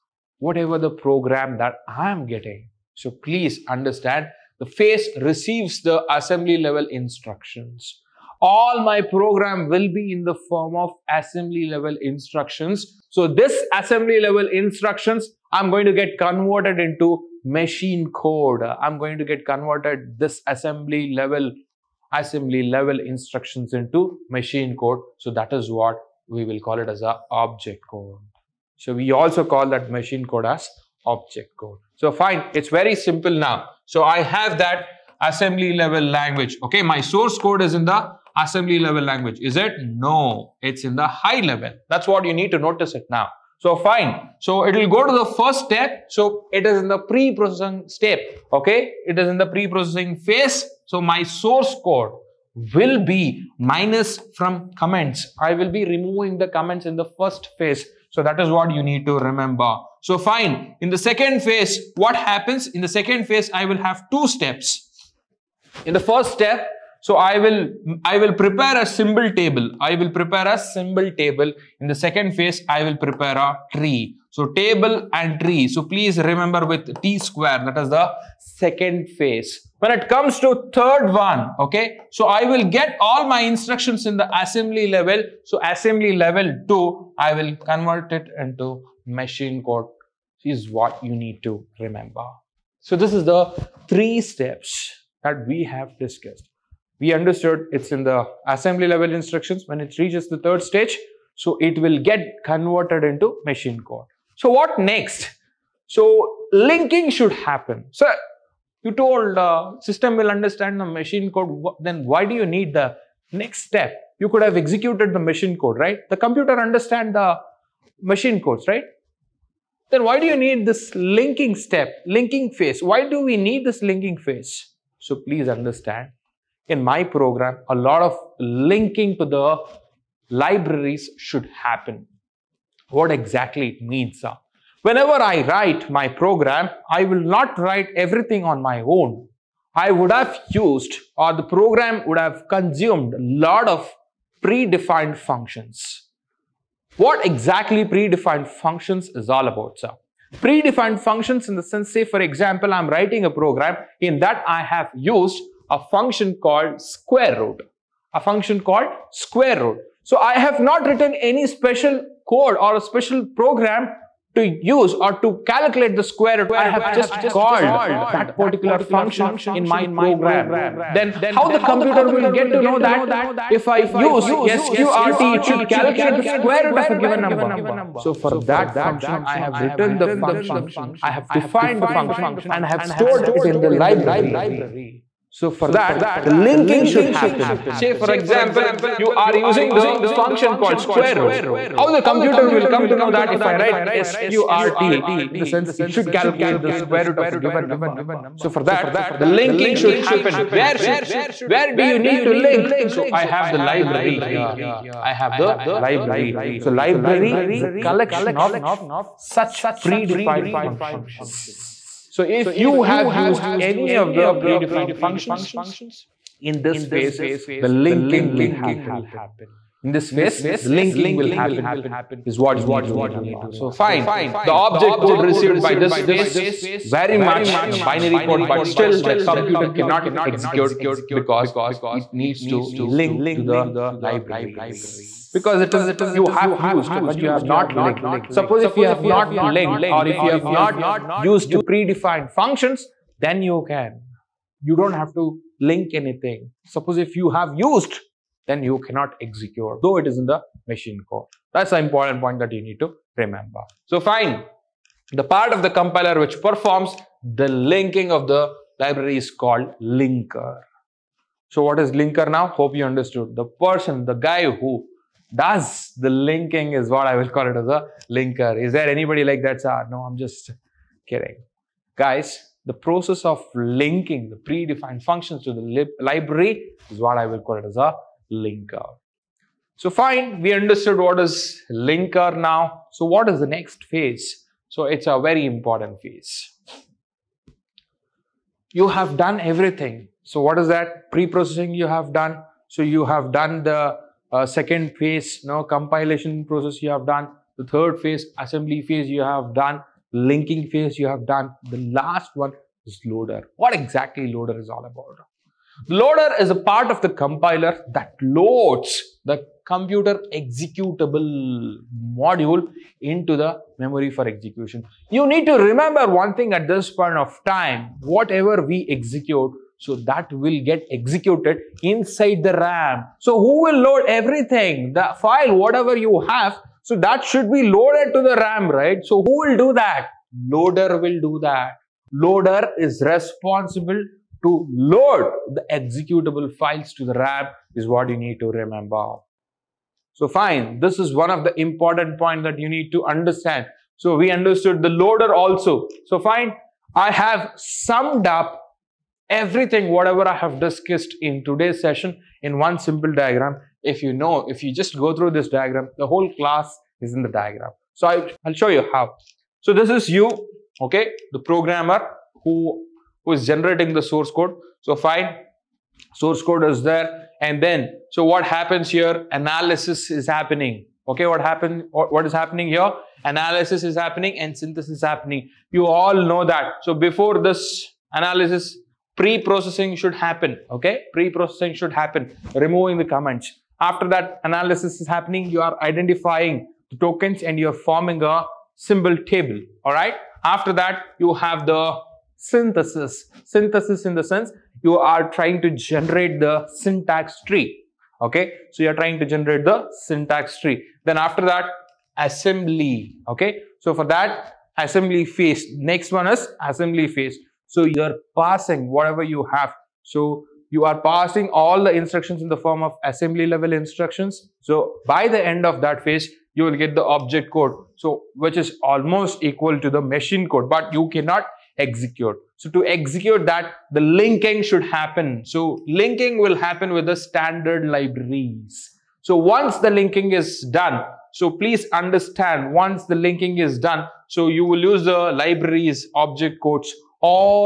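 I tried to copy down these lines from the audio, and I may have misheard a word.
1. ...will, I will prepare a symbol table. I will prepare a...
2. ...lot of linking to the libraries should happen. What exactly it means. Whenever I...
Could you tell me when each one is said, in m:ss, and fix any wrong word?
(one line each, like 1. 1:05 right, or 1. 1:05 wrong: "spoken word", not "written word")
1. 1:07 right
2. 2:07 right.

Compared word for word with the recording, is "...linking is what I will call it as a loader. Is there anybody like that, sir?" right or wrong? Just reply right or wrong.
wrong.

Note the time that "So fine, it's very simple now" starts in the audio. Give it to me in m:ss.
0:31.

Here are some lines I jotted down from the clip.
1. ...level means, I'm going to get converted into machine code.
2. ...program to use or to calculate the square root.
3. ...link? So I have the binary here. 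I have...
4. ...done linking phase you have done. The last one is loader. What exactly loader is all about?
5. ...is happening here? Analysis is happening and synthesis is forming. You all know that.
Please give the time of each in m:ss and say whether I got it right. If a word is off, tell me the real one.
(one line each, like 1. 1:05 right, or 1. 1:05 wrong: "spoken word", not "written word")
1. 0:14 wrong: "instructions", not "means"
2. 2:43 right
3. 3:22 wrong: "library", not "binary"
4. 4:59 right
5. 6:12 wrong: "happening", not "forming".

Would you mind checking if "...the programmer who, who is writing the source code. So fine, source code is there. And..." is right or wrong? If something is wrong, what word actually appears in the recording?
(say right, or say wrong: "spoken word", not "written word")
wrong: "generating", not "writing".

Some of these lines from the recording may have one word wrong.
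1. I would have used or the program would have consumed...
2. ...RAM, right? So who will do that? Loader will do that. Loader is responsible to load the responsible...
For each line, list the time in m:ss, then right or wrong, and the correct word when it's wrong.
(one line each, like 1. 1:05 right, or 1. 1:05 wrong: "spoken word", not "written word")
1. 2:19 right
2. 5:28 wrong: "executable", not "responsible".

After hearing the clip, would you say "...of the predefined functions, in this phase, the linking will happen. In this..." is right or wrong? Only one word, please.
right.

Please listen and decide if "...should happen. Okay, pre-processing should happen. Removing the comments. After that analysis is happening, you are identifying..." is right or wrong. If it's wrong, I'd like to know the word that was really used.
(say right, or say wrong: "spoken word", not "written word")
right.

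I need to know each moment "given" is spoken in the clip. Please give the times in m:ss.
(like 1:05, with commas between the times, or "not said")
2:56, 3:17.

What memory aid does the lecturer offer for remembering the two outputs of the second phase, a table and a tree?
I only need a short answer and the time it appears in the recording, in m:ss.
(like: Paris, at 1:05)
T square, at 1:17.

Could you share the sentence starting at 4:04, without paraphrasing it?
You don't have to link anything.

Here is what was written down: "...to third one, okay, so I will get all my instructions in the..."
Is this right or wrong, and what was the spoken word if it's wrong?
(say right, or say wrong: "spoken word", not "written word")
right.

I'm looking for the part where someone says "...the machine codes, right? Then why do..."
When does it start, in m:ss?
1:57.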